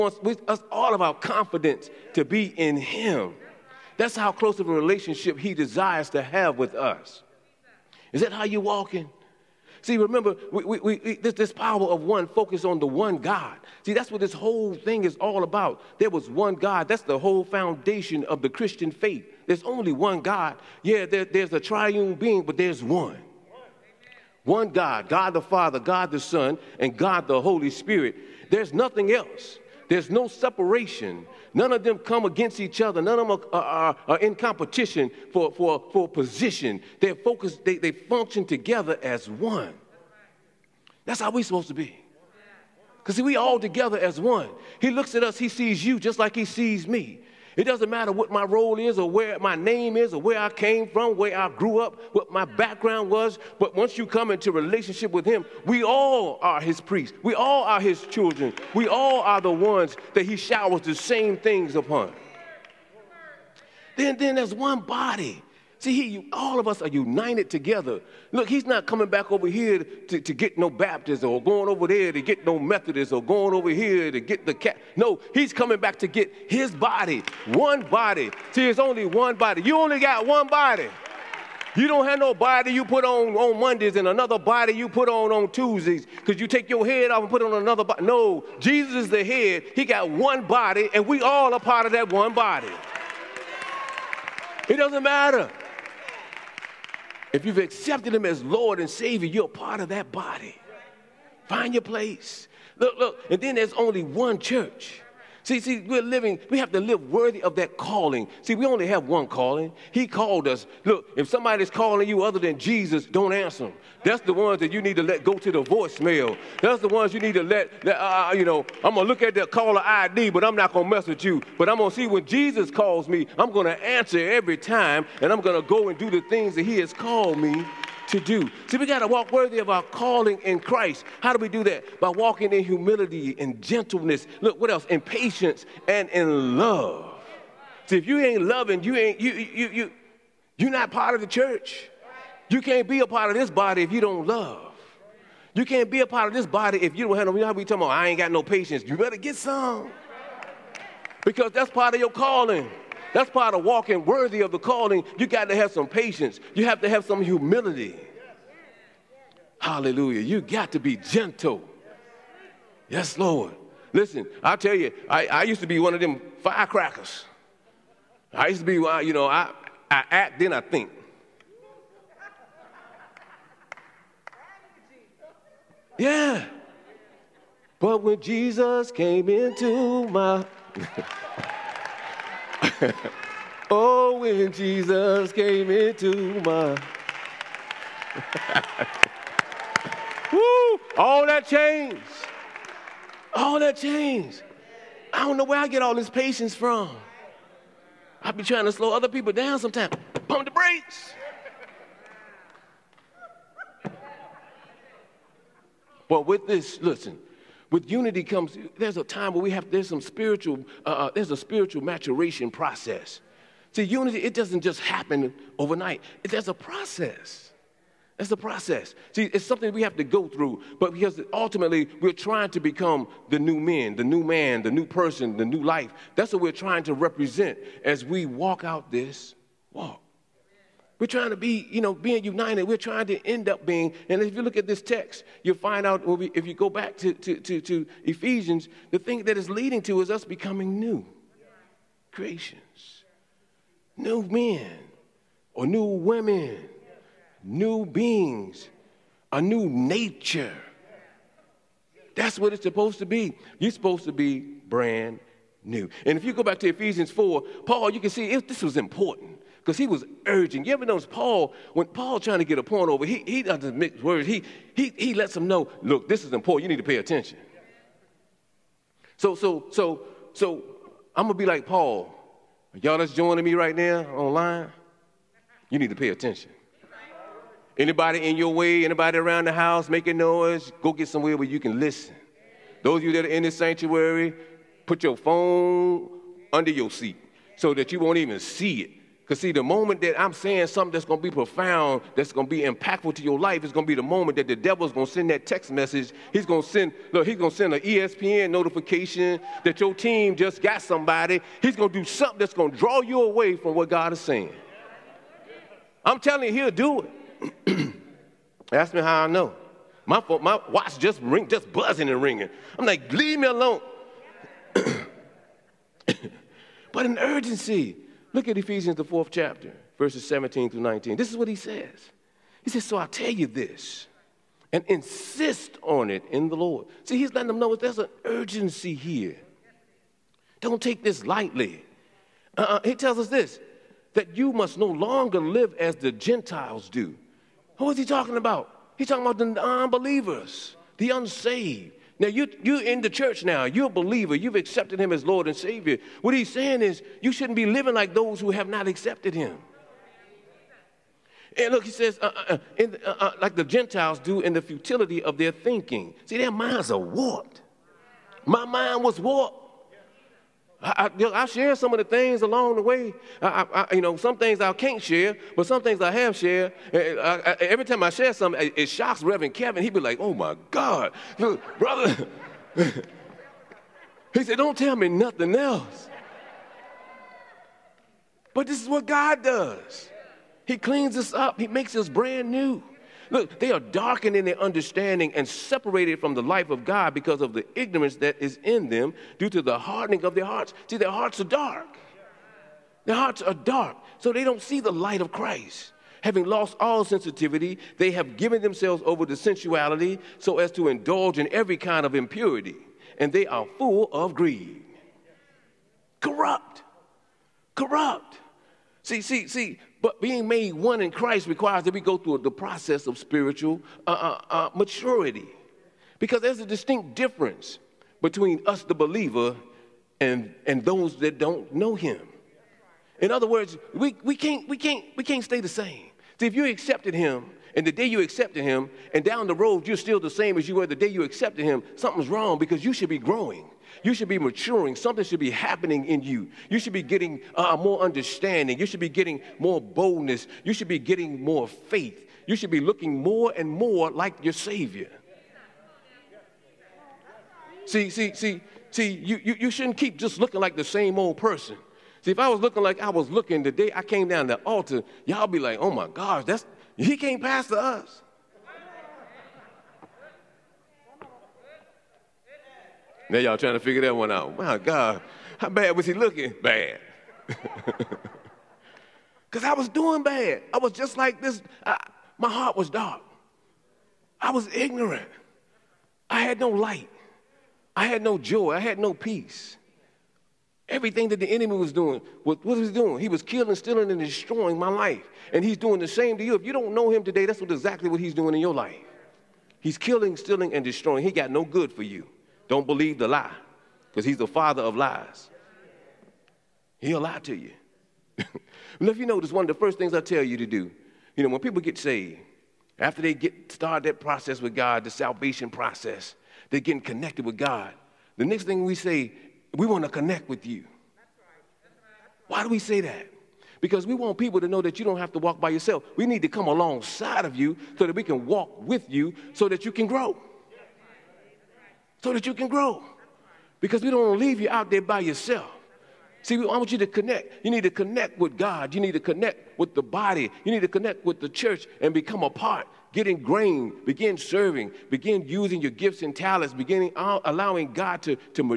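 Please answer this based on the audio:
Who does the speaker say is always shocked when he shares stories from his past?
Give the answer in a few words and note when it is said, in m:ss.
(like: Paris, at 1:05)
Reverend Kevin, at 6:09.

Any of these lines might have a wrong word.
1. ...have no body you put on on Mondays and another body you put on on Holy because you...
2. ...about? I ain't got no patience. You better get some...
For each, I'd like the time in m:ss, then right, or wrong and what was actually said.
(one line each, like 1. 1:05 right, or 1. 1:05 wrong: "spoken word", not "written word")
1. 1:22 wrong: "Tuesdays", not "Holy"
2. 2:27 right.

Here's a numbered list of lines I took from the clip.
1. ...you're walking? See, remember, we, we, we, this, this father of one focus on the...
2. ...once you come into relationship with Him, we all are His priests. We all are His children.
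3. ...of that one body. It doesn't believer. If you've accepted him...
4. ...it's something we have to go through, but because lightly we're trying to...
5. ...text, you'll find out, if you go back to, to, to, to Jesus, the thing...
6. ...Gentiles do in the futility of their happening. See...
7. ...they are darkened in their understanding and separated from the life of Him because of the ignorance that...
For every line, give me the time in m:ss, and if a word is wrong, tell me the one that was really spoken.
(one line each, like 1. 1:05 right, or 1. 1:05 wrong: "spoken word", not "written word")
1. 0:08 wrong: "power", not "father"
2. 0:53 right
3. 1:31 wrong: "matter", not "believer"
4. 3:39 wrong: "ultimately", not "lightly"
5. 3:54 wrong: "Ephesians", not "Jesus"
6. 5:53 wrong: "thinking", not "happening"
7. 6:23 wrong: "God", not "Him".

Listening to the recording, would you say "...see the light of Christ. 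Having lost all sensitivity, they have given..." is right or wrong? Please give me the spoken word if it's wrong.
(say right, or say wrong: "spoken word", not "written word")
right.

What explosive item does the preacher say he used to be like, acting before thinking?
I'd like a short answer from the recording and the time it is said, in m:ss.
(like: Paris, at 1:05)
firecrackers, at 2:46.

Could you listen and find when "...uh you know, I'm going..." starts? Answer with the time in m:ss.
1:58.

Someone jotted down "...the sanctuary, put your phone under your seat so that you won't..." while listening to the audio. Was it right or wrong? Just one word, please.
right.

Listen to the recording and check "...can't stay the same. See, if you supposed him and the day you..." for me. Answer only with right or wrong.
wrong.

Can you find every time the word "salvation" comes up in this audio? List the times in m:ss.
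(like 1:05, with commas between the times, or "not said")
8:25.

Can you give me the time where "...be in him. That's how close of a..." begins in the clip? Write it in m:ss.
0:02.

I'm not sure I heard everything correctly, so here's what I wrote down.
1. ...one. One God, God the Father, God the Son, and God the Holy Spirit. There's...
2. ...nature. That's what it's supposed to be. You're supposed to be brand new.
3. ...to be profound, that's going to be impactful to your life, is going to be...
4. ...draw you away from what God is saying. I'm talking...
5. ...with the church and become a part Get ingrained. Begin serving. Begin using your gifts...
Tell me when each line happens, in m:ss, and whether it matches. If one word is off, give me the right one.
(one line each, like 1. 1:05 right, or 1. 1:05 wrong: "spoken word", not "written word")
1. 0:22 right
2. 4:09 right
3. 4:51 right
4. 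5:02 wrong: "telling", not "talking"
5. 8:51 right.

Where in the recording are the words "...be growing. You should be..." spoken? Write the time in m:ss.
7:13.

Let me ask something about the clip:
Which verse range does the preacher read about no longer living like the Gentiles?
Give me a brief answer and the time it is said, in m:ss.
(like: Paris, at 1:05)
17 through 19, at 5:19.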